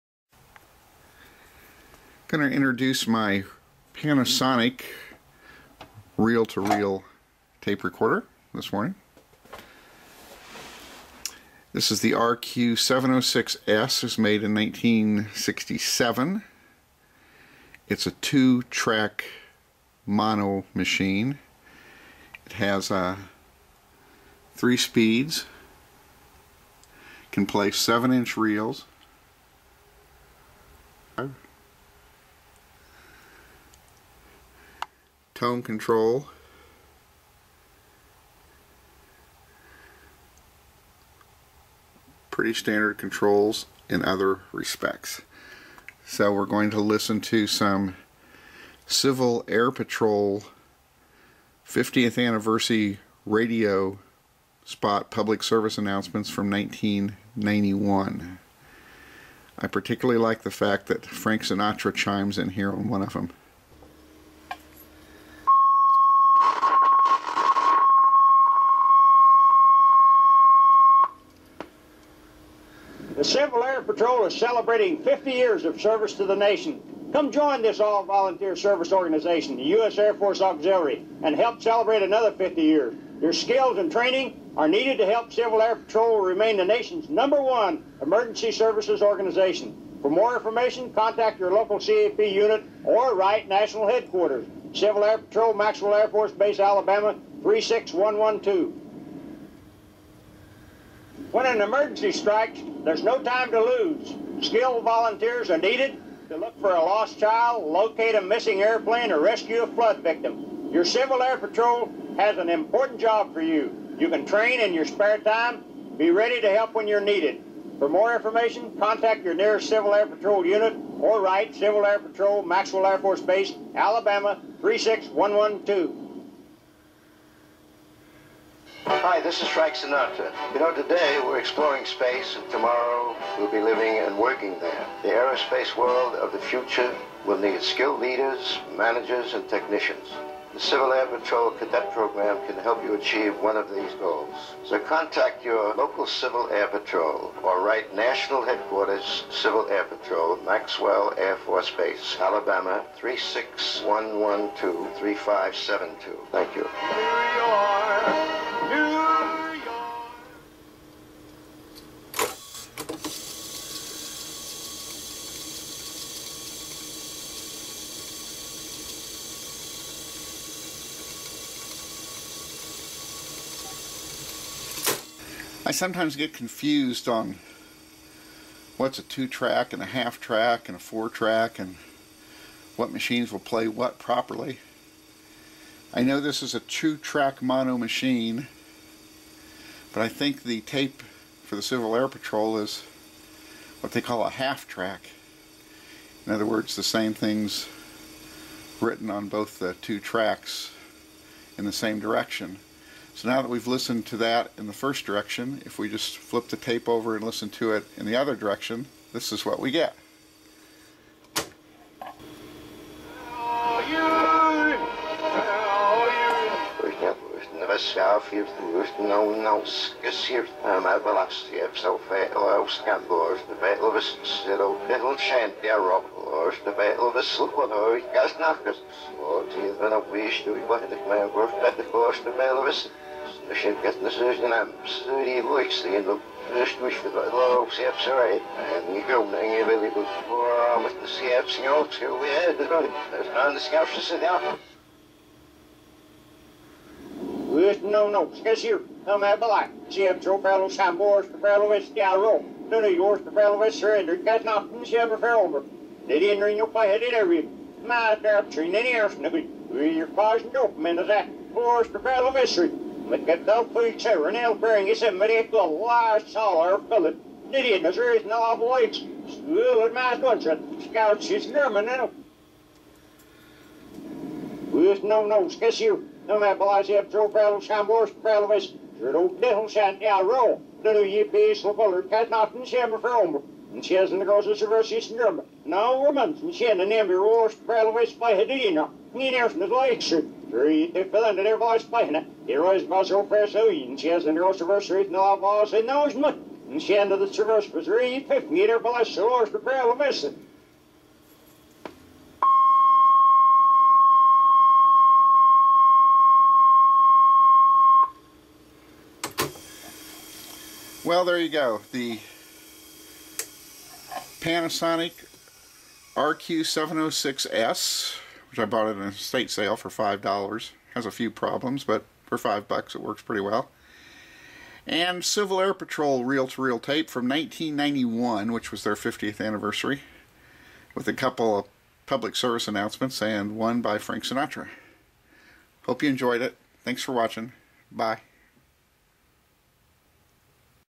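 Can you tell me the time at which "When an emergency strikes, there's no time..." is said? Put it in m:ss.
1:41.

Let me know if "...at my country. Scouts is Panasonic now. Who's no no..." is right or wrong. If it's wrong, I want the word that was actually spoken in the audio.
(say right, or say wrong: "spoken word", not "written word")
wrong: "German", not "Panasonic".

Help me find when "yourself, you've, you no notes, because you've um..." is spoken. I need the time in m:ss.
3:37.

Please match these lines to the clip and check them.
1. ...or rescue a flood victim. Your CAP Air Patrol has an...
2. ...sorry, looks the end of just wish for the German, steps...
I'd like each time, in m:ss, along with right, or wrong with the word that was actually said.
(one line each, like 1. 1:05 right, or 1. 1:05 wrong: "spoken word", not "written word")
1. 1:49 wrong: "Civil", not "CAP"
2. 3:54 wrong: "Lord", not "German".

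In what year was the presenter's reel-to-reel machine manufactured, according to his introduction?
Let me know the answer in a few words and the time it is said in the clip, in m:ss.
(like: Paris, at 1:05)
1967, at 0:14.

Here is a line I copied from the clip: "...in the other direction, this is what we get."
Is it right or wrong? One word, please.
right.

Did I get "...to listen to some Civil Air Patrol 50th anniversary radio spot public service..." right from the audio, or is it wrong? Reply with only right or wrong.
right.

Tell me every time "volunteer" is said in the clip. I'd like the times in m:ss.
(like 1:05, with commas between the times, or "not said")
1:17, 1:44.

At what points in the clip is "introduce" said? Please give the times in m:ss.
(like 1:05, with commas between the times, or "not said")
0:02.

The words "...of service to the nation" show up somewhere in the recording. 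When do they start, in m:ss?
1:15.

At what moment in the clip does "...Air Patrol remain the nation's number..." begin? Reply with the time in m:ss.
1:25.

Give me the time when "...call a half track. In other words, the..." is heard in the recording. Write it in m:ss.
3:14.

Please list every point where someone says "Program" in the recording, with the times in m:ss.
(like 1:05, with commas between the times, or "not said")
2:21.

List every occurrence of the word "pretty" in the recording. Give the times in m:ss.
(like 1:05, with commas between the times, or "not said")
0:42, 5:23.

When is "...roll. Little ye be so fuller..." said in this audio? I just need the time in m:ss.
4:40.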